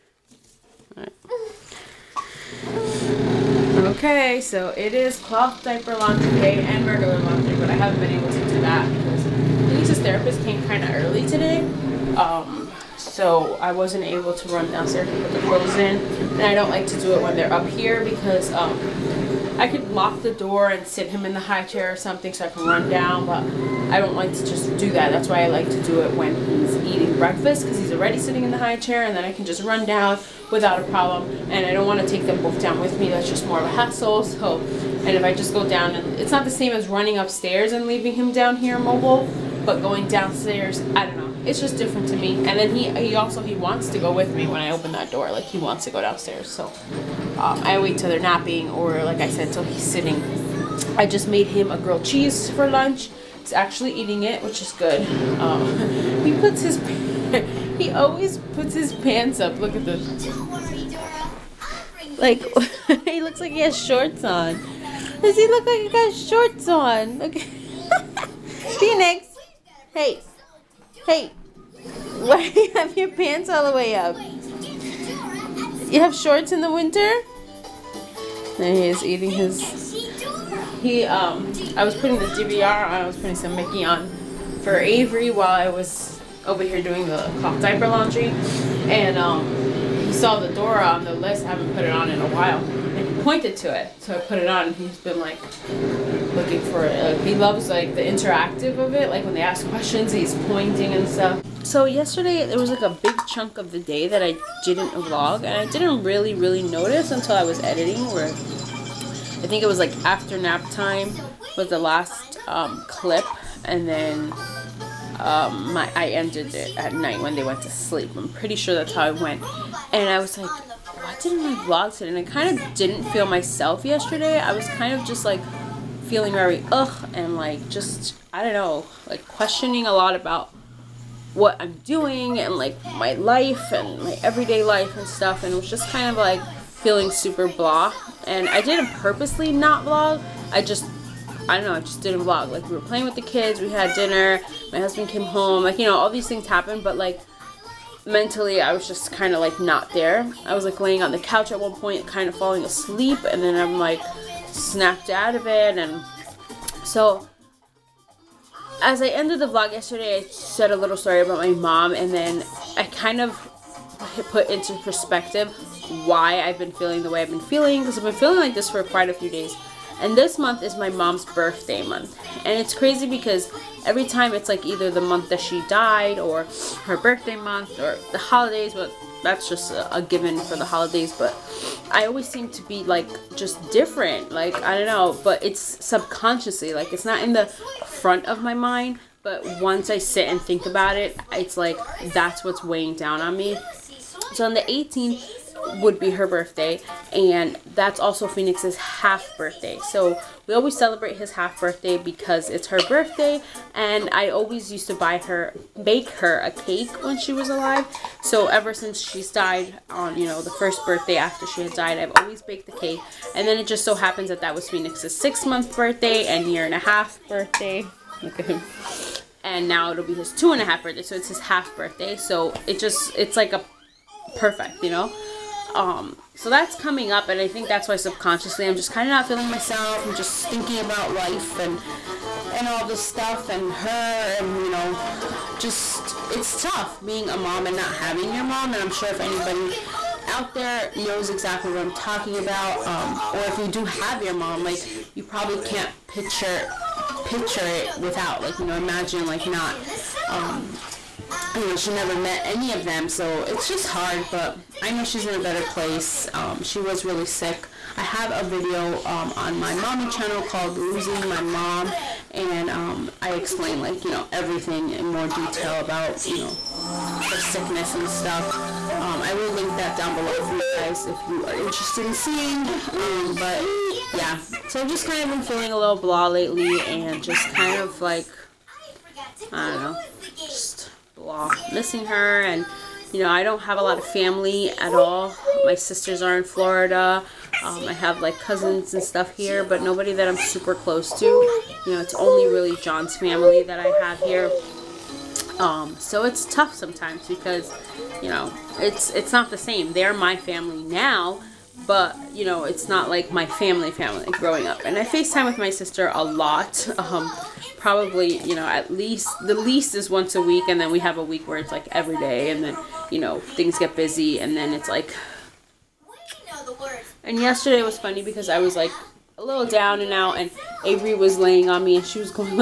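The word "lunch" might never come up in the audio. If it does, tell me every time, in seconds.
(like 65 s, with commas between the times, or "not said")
52 s.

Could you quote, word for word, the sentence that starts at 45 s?
Like he wants to go downstairs.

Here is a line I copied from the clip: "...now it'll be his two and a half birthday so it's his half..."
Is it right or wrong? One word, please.
right.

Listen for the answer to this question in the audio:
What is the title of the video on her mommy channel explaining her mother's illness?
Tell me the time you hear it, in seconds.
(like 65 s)
260 s.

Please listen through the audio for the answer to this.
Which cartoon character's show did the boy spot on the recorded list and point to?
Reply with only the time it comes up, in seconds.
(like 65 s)
90 s.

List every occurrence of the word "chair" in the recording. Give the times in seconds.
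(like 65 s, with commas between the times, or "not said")
21 s, 28 s.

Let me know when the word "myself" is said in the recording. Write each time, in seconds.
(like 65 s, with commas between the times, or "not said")
123 s, 229 s.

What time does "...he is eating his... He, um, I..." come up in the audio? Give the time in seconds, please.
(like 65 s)
78 s.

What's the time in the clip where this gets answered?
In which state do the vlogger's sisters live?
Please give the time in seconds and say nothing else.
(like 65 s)
286 s.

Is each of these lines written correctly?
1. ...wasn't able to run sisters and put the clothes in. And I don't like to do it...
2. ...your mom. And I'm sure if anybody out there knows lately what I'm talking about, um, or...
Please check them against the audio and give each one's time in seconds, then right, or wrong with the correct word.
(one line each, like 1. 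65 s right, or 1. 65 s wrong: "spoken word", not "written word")
1. 13 s wrong: "downstairs", not "sisters"
2. 238 s wrong: "exactly", not "lately".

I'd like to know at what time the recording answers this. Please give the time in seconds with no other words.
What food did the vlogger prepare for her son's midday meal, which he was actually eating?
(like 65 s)
51 s.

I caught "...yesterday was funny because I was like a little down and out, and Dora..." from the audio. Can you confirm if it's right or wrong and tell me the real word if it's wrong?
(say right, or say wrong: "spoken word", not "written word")
wrong: "Avery", not "Dora".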